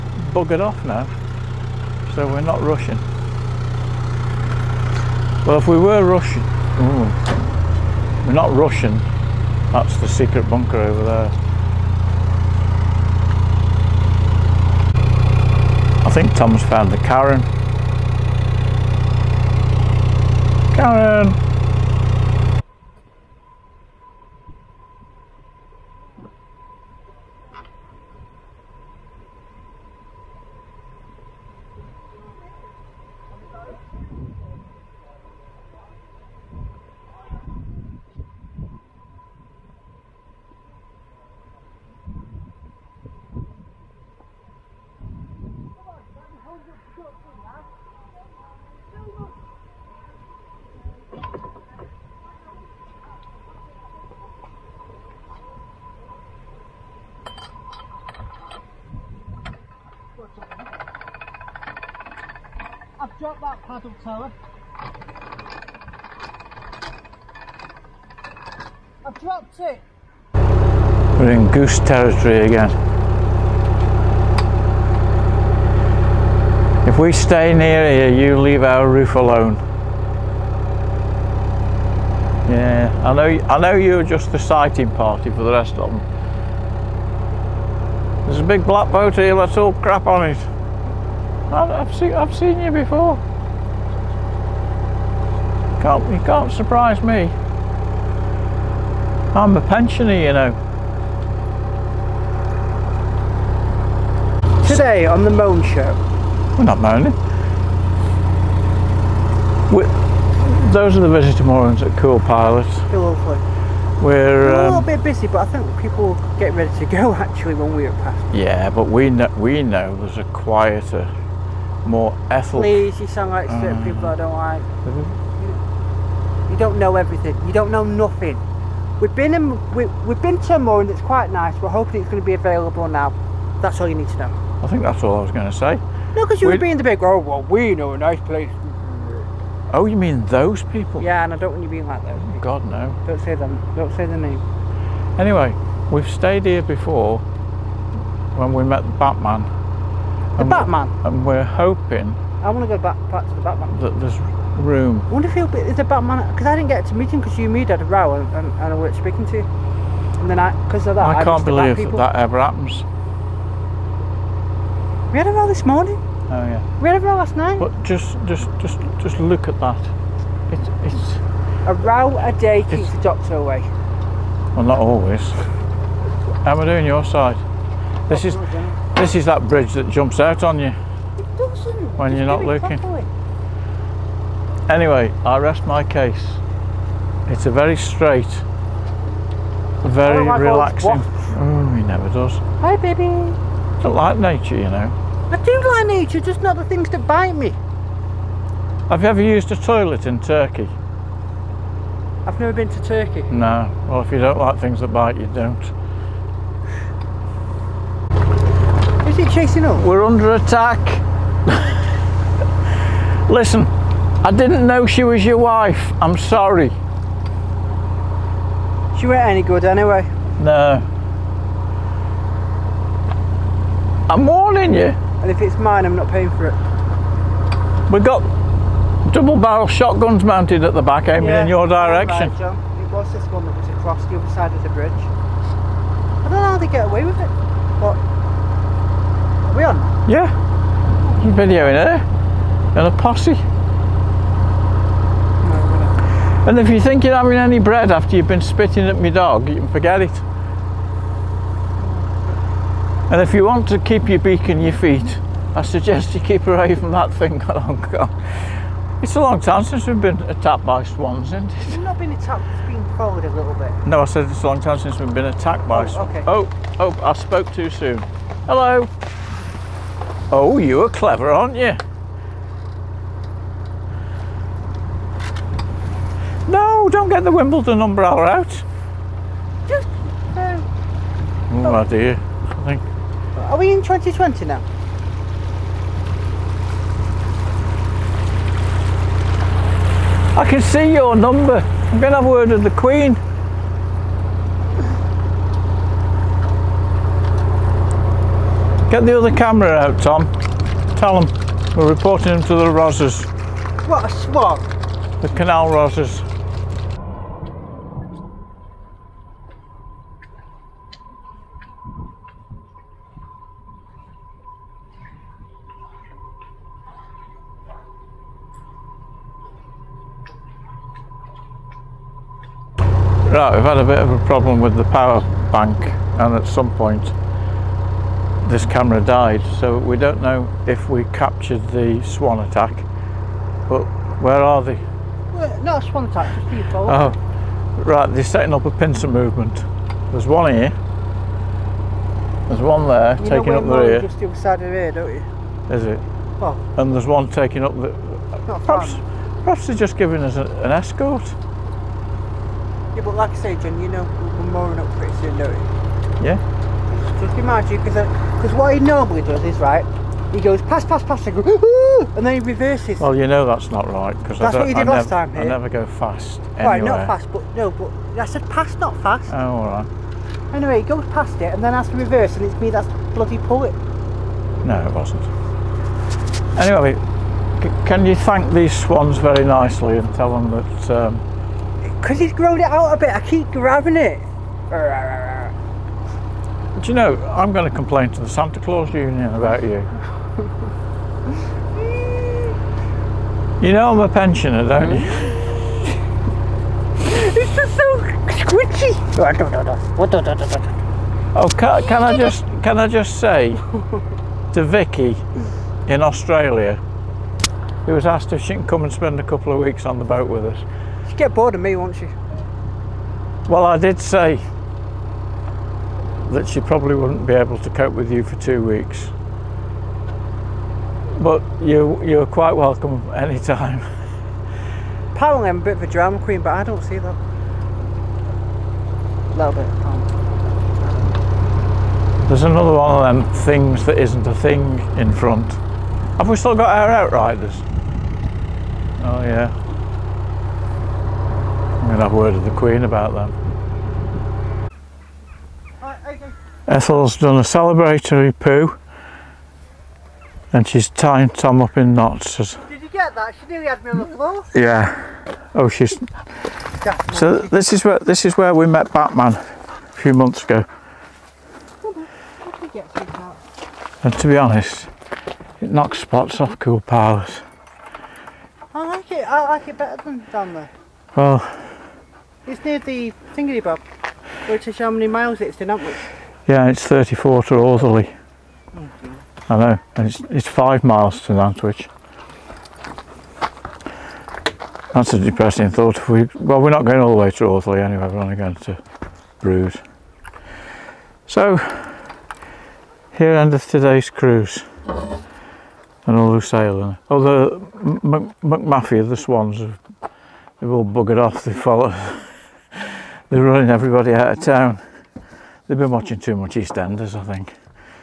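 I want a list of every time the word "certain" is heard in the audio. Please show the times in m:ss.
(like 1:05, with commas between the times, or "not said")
2:03.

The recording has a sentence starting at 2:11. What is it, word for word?
We're hoping it's going to be available now.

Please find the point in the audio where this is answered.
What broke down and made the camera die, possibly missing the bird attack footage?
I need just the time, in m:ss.
5:24.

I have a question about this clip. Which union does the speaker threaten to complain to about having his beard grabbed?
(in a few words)
Santa Claus Union.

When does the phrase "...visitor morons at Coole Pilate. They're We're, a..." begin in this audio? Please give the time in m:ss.
1:51.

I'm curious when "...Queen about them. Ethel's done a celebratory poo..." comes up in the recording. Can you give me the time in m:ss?
7:22.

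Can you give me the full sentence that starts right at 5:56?
Yeah just be mindful because uh, what he normally does is right.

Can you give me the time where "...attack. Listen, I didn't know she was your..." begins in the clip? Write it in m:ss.
3:30.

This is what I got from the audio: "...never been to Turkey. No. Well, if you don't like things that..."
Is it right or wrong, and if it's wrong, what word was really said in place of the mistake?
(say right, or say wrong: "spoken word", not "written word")
right.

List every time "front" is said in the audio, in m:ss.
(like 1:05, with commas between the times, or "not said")
7:15.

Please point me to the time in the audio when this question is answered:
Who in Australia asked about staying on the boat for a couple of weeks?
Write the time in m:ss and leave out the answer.
6:44.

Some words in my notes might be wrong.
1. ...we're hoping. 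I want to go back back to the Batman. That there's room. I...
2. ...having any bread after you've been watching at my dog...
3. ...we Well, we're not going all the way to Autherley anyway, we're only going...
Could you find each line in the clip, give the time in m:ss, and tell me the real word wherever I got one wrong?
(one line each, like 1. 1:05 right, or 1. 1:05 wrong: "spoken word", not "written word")
1. 2:31 right
2. 4:07 wrong: "spitting", not "watching"
3. 8:06 right.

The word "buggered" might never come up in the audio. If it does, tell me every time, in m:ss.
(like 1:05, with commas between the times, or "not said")
0:00, 8:20.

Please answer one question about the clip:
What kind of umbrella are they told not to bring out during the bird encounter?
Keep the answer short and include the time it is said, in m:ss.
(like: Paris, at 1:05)
Wimbledon umbrella, at 4:37.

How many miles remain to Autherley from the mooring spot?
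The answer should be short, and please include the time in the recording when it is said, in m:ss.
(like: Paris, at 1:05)
34, at 7:56.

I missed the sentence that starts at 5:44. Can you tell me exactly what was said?
just the other side of the rear, don't you?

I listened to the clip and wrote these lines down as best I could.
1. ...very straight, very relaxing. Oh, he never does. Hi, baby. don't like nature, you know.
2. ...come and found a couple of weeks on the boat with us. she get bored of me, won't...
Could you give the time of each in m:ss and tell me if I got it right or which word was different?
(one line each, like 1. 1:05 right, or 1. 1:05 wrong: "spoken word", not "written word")
1. 3:07 right
2. 6:48 wrong: "spend", not "found".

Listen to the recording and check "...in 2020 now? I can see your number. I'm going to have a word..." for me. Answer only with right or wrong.
right.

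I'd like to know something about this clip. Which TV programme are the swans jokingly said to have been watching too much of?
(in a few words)
EastEnders.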